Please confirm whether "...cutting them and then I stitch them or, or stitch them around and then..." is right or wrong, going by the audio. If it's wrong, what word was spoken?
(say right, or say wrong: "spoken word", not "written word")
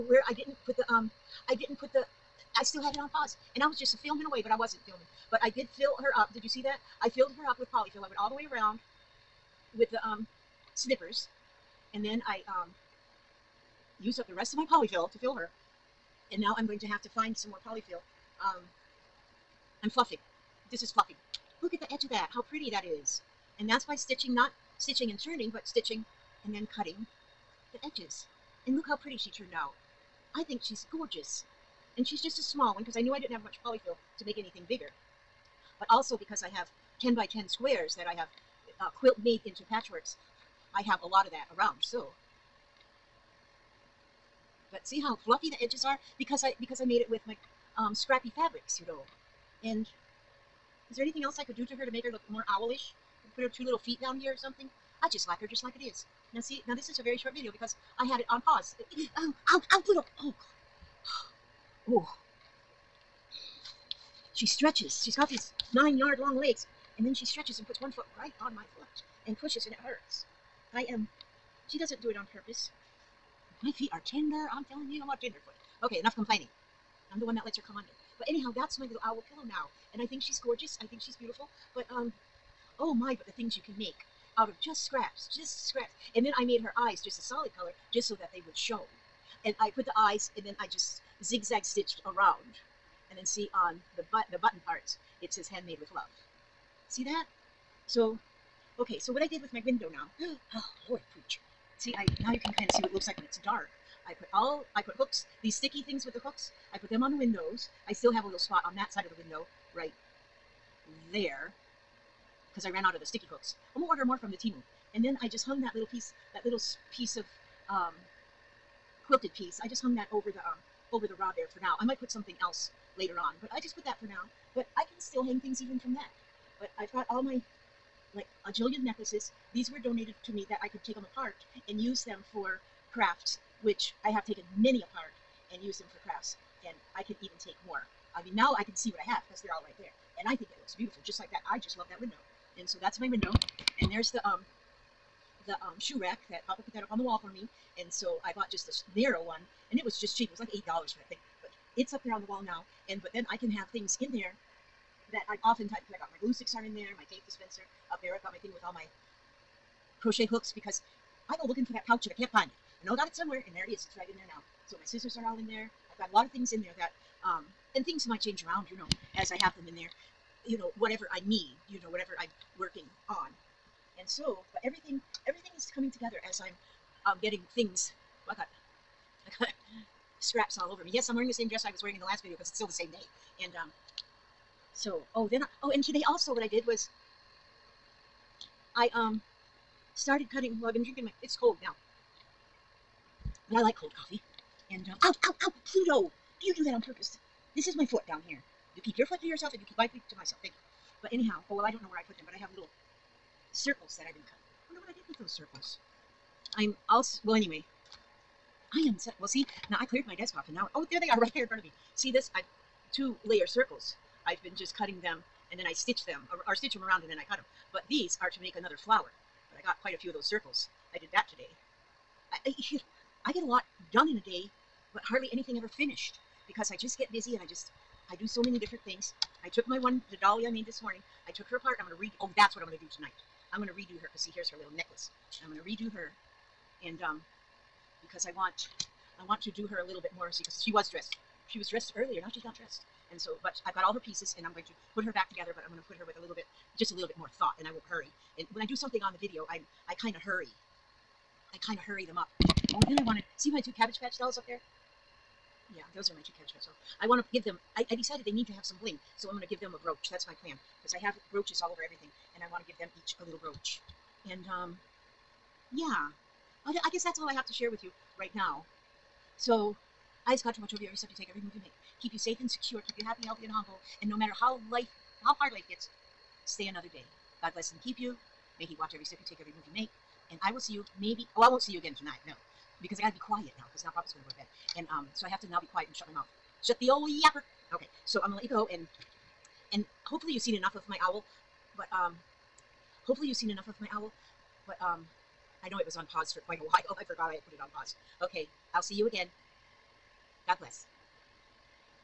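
right.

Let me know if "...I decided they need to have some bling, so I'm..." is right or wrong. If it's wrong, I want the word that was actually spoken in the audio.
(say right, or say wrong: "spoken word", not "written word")
right.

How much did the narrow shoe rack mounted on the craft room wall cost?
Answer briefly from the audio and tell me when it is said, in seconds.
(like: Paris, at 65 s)
$8, at 150 s.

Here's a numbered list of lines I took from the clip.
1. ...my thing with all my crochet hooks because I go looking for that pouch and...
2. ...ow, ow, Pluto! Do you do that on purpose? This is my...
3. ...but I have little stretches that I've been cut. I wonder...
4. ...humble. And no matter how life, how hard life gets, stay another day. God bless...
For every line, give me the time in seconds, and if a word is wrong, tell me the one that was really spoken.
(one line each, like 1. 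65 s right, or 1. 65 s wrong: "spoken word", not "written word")
1. 158 s right
2. 195 s right
3. 202 s wrong: "circles", not "stretches"
4. 273 s right.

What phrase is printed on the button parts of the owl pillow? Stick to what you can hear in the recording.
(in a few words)
Handmade with love.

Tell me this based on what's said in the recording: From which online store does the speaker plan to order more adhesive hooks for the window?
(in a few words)
Temu.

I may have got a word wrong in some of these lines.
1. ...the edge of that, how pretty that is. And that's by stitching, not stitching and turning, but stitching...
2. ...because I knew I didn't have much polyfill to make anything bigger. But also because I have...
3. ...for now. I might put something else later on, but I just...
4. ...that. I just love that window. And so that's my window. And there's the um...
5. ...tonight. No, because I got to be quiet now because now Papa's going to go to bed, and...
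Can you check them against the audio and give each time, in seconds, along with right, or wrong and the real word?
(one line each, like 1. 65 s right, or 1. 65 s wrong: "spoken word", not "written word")
1. 21 s right
2. 32 s right
3. 121 s right
4. 141 s right
5. 281 s right.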